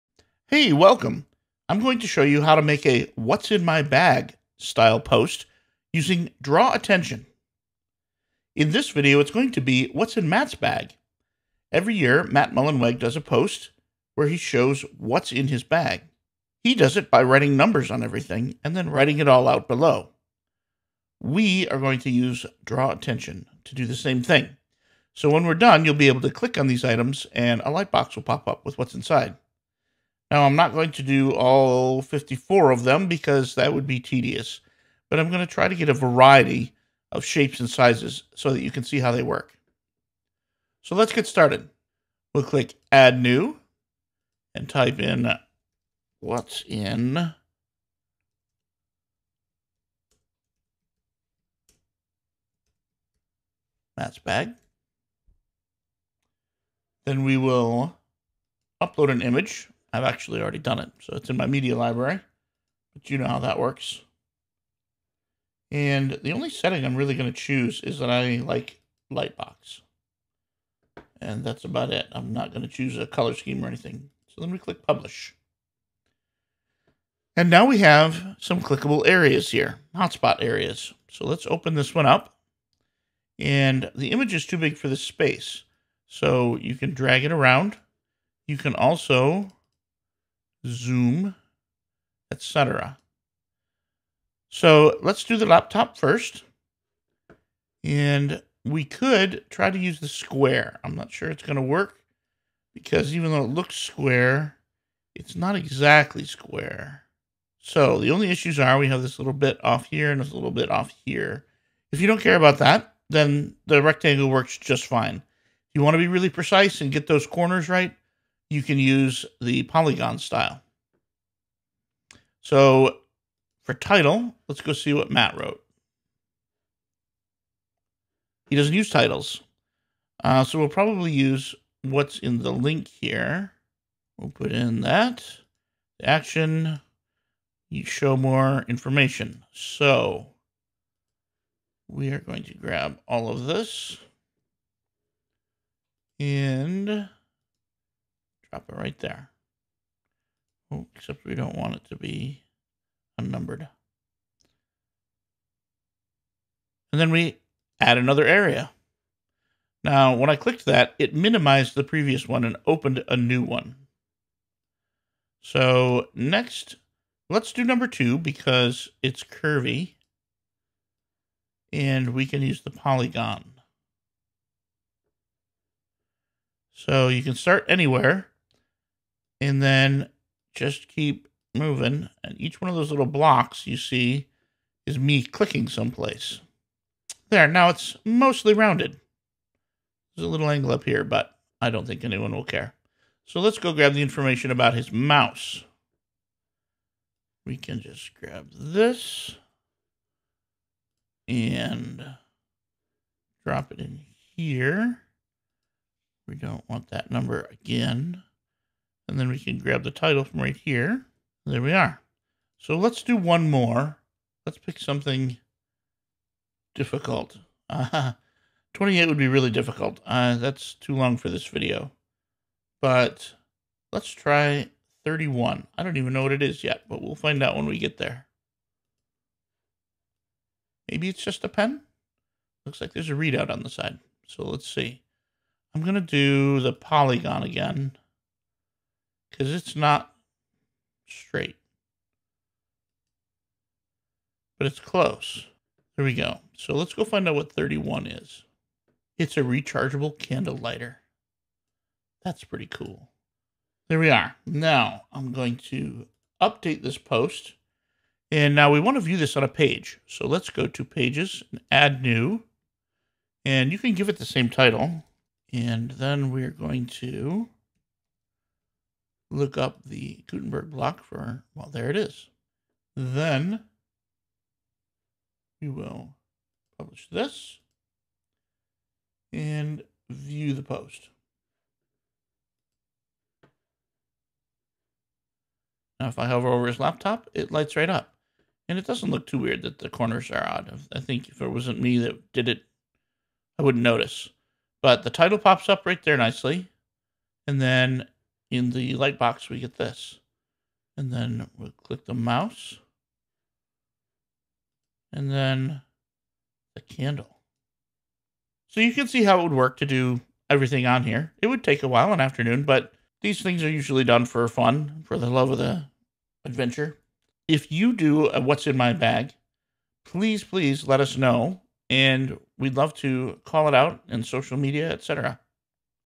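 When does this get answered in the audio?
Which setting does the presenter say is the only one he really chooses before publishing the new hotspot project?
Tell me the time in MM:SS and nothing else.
01:09.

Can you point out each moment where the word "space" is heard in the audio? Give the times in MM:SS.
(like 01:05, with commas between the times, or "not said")
01:25.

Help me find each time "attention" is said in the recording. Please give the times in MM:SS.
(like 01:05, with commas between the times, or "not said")
00:06, 00:22.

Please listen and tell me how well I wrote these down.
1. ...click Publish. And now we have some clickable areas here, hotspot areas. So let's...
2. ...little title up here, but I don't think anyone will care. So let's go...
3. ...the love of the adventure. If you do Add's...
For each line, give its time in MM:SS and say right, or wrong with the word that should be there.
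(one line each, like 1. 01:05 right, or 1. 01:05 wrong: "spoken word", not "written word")
1. 01:14 right
2. 03:10 wrong: "angle", not "title"
3. 05:15 wrong: "What", not "Add".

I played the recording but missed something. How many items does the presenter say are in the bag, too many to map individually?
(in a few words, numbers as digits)
54.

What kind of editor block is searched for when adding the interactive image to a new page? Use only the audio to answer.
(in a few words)
Gutenberg block.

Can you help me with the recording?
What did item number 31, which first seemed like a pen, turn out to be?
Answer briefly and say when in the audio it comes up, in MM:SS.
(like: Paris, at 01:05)
A rechargeable candle lighter, at 04:09.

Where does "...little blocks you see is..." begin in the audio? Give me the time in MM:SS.
03:02.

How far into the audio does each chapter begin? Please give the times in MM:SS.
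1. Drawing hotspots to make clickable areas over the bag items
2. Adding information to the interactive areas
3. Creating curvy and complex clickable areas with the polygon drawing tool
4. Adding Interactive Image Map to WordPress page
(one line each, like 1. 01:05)
1. 01:37
2. 02:02
3. 02:47
4. 04:18.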